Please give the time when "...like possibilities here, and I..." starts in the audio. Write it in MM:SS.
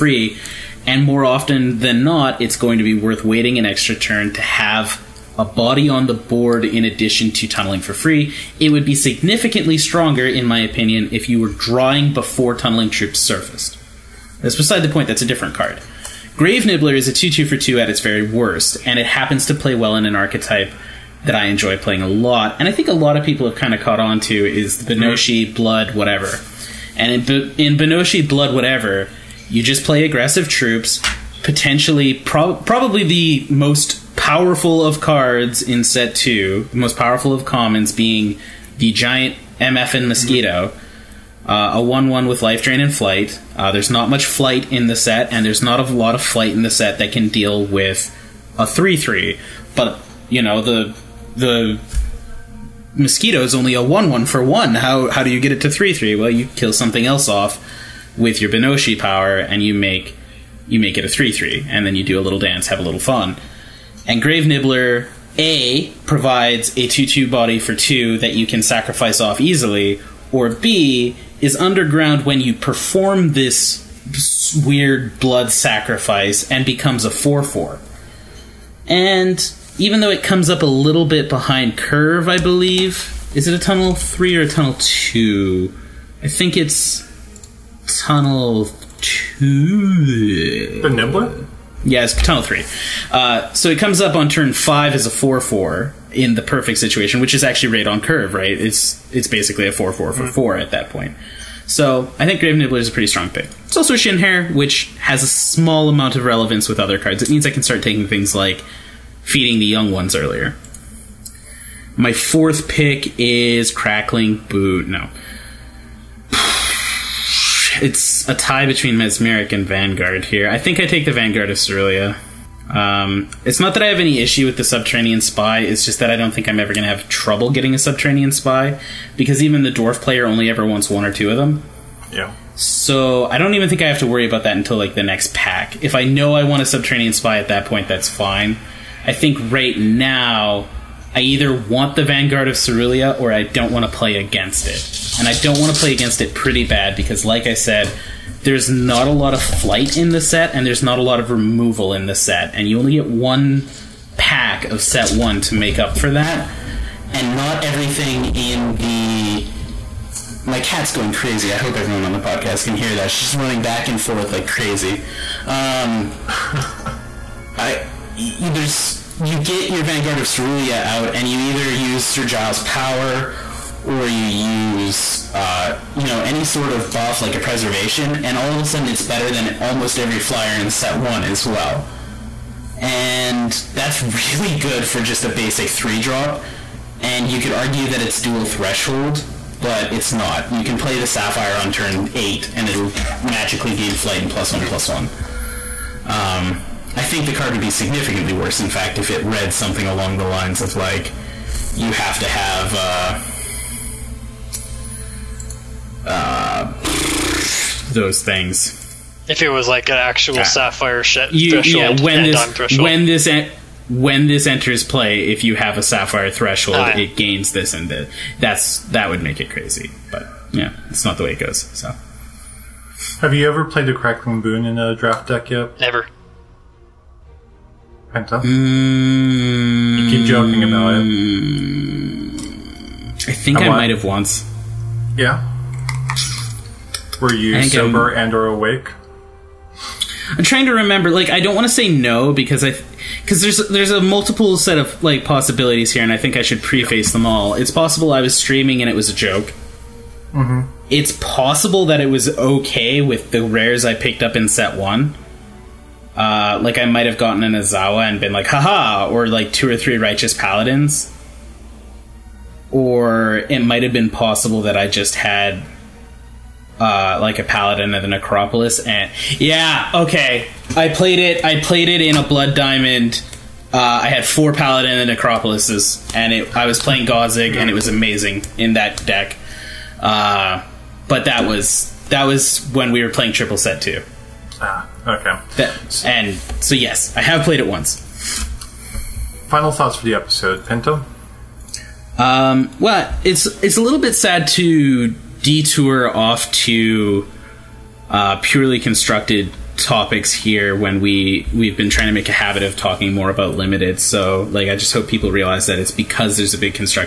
04:05.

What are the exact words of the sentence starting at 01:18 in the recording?
And even though it comes up a little bit behind curve, I believe.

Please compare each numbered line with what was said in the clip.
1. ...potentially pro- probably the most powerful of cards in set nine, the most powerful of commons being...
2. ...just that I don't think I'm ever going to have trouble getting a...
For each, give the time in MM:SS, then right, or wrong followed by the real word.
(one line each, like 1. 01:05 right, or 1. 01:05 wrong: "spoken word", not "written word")
1. 00:31 wrong: "two", not "nine"
2. 02:05 right.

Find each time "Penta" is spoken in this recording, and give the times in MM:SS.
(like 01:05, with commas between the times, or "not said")
03:48, 04:50.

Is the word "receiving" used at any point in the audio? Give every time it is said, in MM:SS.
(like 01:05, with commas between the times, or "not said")
not said.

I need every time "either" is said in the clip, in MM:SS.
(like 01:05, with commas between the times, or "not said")
02:21, 02:51.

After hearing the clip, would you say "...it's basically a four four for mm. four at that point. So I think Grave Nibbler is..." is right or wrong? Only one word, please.
right.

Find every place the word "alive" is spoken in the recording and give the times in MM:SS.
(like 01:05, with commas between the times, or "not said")
not said.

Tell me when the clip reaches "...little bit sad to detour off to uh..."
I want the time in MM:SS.
04:53.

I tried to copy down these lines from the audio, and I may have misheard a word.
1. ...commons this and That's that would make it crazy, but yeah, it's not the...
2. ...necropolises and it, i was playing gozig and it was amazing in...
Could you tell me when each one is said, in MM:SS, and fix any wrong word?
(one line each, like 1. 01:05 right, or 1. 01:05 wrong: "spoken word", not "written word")
1. 03:37 wrong: "gains", not "commons"
2. 04:35 right.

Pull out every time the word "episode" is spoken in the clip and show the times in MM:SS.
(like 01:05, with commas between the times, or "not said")
04:50.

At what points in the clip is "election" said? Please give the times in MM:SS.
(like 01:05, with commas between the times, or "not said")
not said.